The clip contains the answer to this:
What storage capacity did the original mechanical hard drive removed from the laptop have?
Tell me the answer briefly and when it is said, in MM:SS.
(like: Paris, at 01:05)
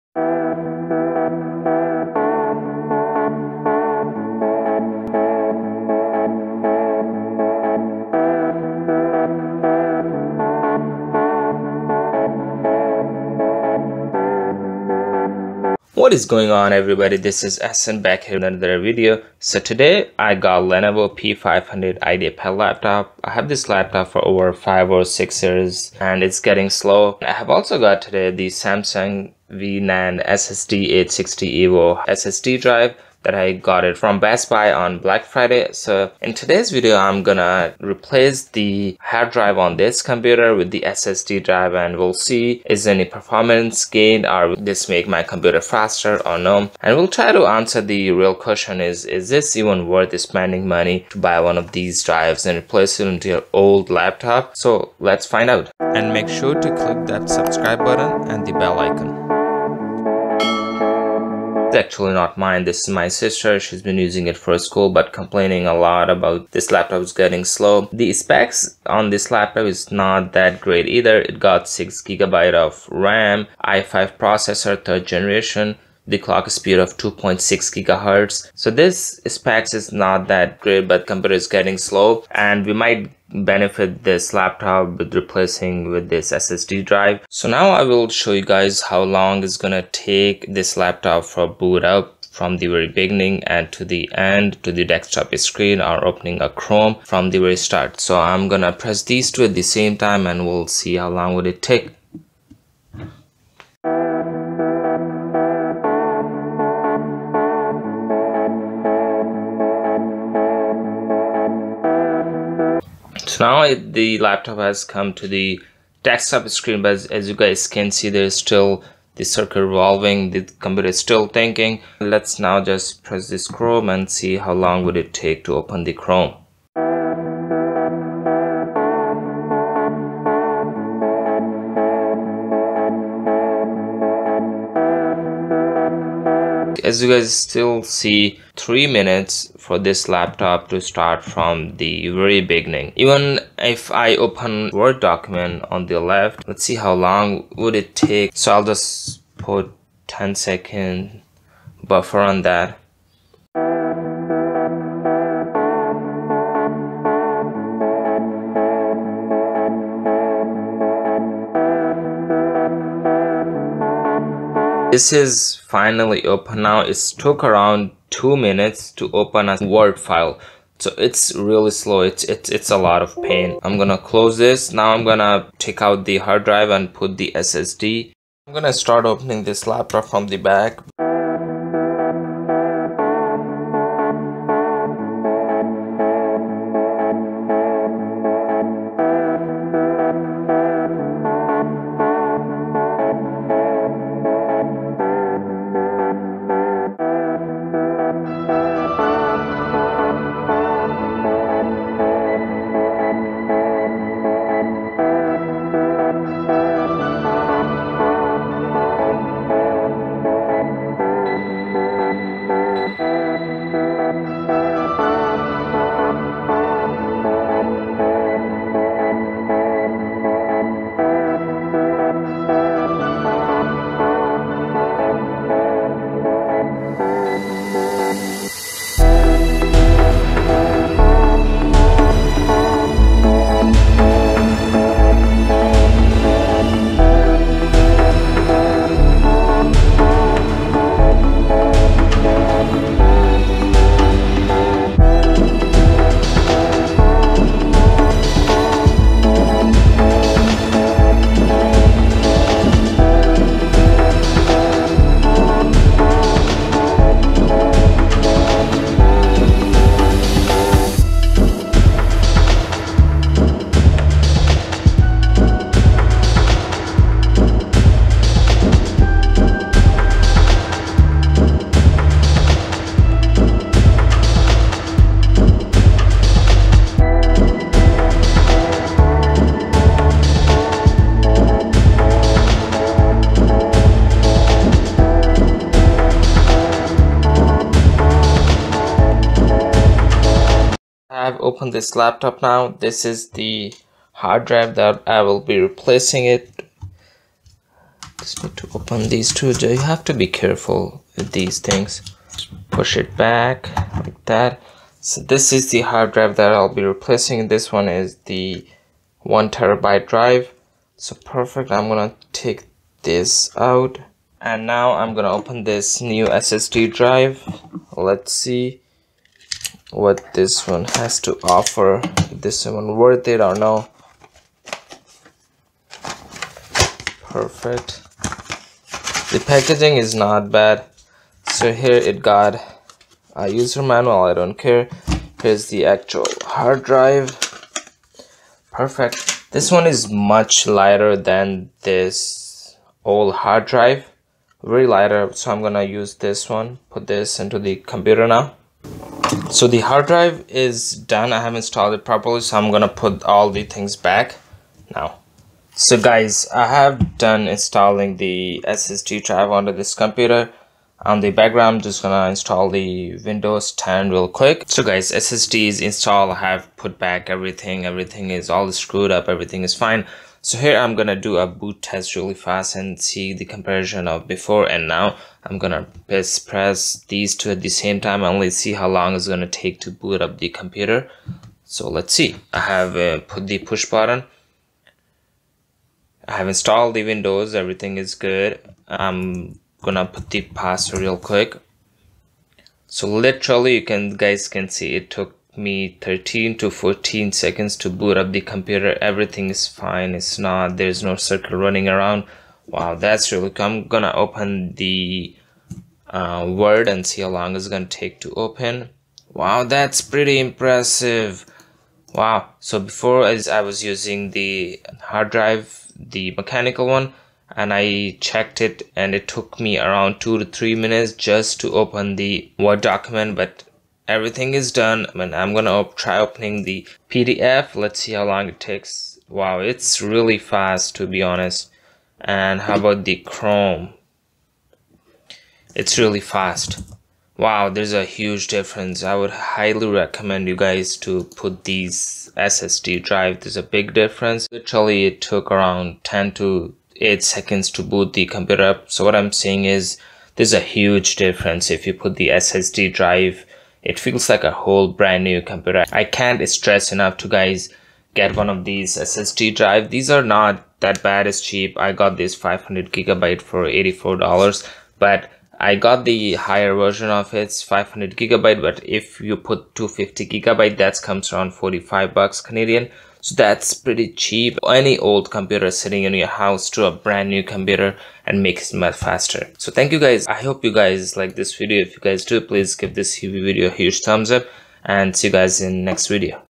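1 terabyte, at 05:09.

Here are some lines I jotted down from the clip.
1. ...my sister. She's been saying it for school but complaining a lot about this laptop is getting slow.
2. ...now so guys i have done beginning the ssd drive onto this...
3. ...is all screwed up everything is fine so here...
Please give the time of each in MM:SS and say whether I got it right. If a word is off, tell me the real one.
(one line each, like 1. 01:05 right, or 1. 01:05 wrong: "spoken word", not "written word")
1. 01:02 wrong: "using", not "saying"
2. 05:54 wrong: "installing", not "beginning"
3. 06:08 right.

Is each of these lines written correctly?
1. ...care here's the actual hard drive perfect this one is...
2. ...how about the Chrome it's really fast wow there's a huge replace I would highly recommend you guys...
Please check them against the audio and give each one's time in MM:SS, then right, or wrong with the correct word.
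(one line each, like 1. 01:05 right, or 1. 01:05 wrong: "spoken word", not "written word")
1. 05:34 right
2. 07:12 wrong: "difference", not "replace".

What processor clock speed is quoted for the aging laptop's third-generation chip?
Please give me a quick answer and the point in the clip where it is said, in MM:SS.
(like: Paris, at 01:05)
2.6 gigahertz, at 01:16.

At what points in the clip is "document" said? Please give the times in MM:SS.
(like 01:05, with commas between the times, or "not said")
02:24, 07:02.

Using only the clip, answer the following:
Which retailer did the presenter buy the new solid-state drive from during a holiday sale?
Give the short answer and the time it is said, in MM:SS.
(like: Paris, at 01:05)
Best Buy, at 00:34.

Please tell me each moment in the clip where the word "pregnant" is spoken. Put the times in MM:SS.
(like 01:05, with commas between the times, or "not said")
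not said.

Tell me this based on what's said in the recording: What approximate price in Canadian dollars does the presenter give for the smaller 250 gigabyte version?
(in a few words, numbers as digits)
45 dollars.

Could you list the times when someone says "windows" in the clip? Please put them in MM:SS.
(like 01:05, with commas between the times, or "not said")
06:03, 06:27.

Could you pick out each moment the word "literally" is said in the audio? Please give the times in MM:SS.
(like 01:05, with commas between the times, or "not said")
06:33, 07:24.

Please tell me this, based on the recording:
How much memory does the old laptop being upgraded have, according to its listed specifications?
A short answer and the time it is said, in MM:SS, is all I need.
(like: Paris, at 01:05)
6 gigabytes, at 01:11.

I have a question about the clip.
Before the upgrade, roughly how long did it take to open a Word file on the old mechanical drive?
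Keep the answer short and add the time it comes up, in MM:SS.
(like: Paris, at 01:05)
2 minutes, at 02:48.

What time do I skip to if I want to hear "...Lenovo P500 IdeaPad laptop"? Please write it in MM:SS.
00:20.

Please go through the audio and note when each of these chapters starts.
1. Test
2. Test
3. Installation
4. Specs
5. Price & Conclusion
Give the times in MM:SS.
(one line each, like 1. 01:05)
1. 01:26
2. 05:55
3. 02:53
4. 01:00
5. 07:23.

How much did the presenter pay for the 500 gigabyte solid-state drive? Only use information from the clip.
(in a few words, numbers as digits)
$84.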